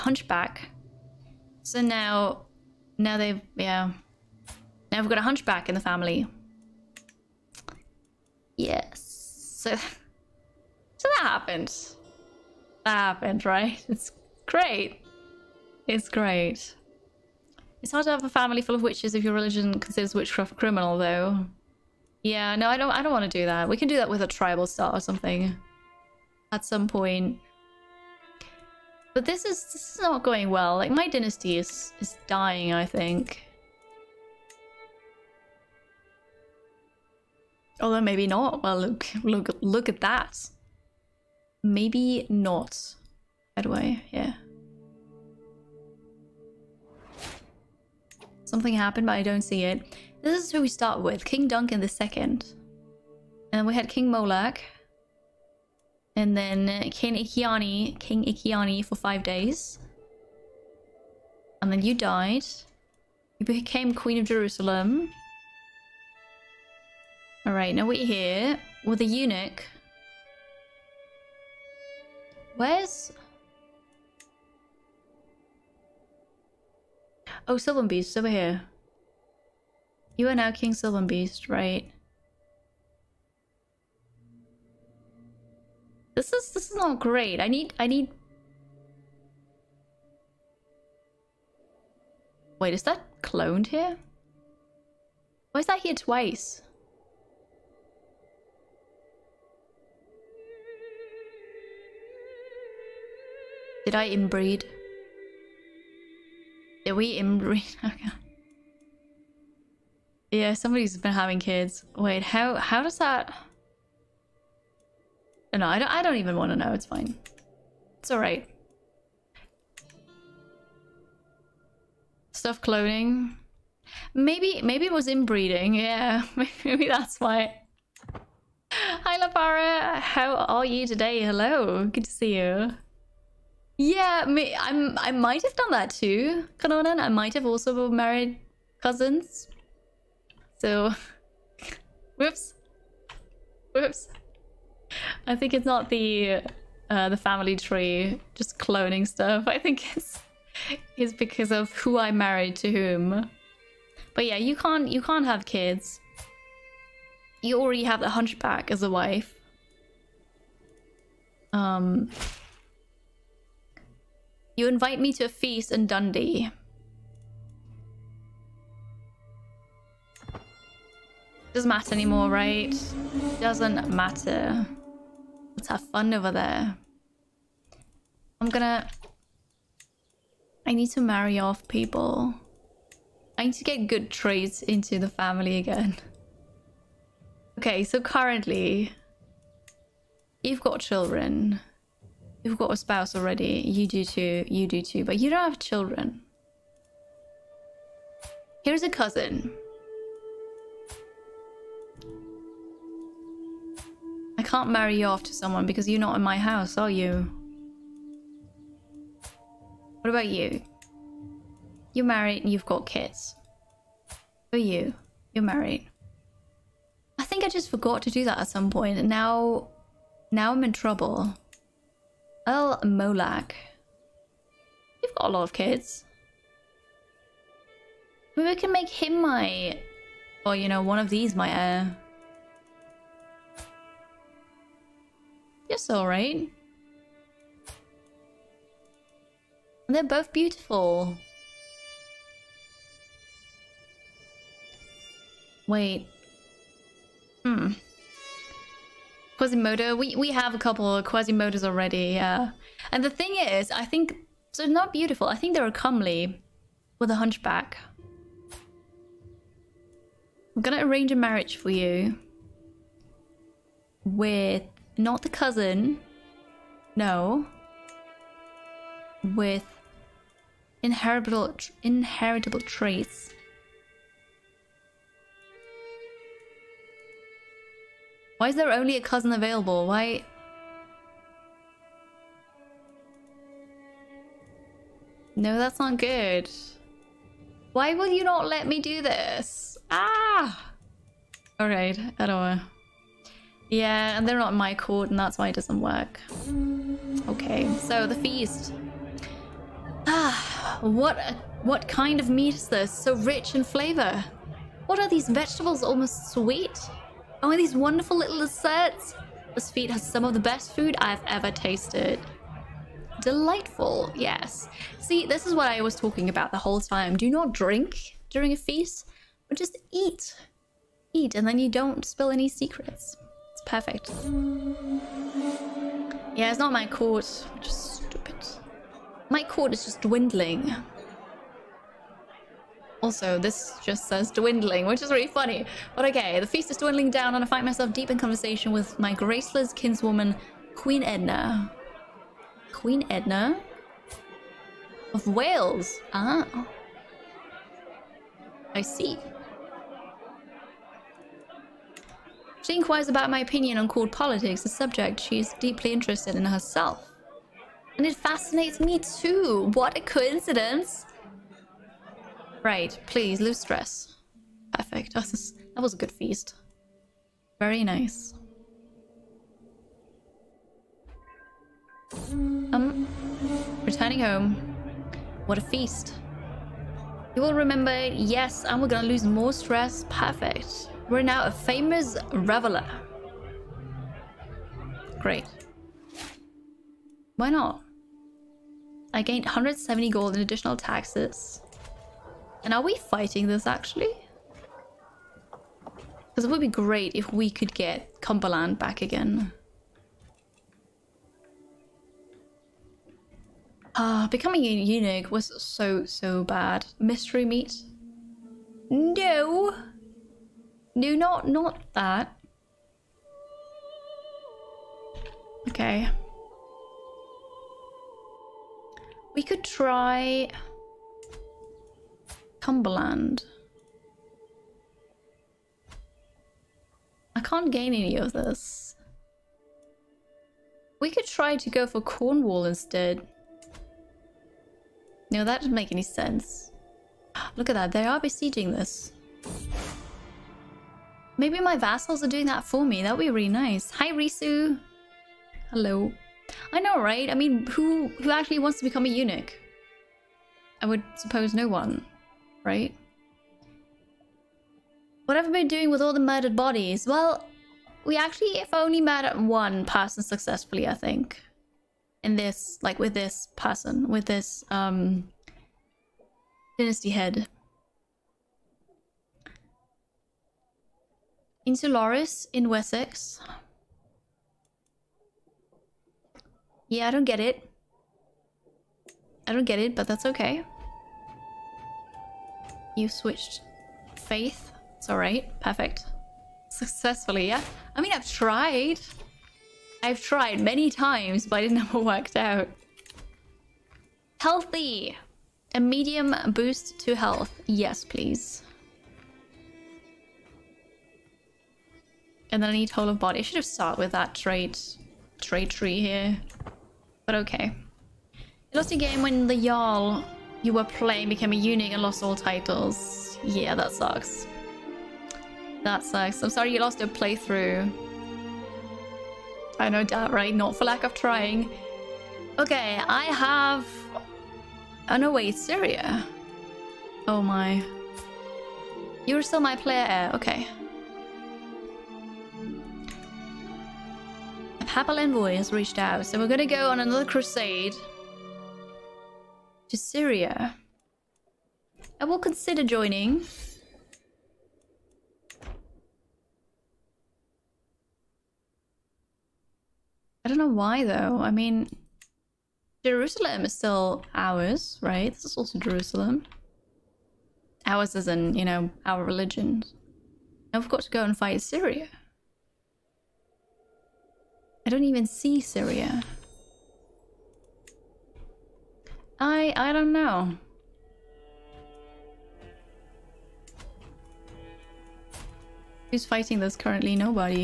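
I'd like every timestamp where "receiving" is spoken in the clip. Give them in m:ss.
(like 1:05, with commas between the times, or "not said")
not said.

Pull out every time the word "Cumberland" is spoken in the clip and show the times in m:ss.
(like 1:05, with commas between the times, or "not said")
6:38, 7:02.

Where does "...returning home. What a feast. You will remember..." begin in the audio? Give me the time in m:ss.
6:13.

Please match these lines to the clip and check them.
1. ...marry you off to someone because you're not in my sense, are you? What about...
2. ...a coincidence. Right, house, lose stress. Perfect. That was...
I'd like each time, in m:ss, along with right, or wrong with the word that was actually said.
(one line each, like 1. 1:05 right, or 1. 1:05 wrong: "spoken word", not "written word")
1. 3:24 wrong: "house", not "sense"
2. 5:59 wrong: "please", not "house".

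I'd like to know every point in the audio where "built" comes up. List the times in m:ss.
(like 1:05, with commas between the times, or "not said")
not said.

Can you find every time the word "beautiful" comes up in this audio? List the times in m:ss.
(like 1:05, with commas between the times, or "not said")
4:00, 4:14.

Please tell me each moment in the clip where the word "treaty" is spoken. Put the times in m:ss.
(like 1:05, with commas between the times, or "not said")
not said.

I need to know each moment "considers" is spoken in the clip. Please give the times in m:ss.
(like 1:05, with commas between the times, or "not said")
0:19, 9:02.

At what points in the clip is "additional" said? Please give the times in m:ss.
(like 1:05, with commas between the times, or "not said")
6:30.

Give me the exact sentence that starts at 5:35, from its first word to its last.
But okay, the feast is dwindling down and I find myself deep in conversation with my graceless kinswoman, Queen Edna.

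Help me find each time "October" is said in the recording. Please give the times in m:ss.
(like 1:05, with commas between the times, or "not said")
not said.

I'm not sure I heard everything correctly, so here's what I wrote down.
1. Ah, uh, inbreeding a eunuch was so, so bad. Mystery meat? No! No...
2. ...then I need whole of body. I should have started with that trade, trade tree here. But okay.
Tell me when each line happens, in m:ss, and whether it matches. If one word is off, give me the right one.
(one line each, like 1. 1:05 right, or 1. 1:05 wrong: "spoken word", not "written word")
1. 6:43 wrong: "becoming", not "inbreeding"
2. 8:22 right.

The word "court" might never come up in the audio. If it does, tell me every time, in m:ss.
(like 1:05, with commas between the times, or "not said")
4:54, 5:29, 5:53.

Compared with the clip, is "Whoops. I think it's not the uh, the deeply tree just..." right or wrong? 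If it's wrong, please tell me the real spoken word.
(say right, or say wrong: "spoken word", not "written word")
wrong: "family", not "deeply".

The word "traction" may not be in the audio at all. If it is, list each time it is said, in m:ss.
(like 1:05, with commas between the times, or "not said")
not said.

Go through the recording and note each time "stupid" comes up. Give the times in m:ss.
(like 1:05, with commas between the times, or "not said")
5:27.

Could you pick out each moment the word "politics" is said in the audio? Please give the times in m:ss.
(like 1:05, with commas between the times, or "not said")
5:54.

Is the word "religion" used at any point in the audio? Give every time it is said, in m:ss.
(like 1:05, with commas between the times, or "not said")
0:19, 9:19.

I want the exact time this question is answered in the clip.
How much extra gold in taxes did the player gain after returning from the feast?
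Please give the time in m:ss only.
6:29.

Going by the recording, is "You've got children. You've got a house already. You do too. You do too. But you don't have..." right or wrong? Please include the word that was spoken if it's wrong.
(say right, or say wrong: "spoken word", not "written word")
wrong: "spouse", not "house".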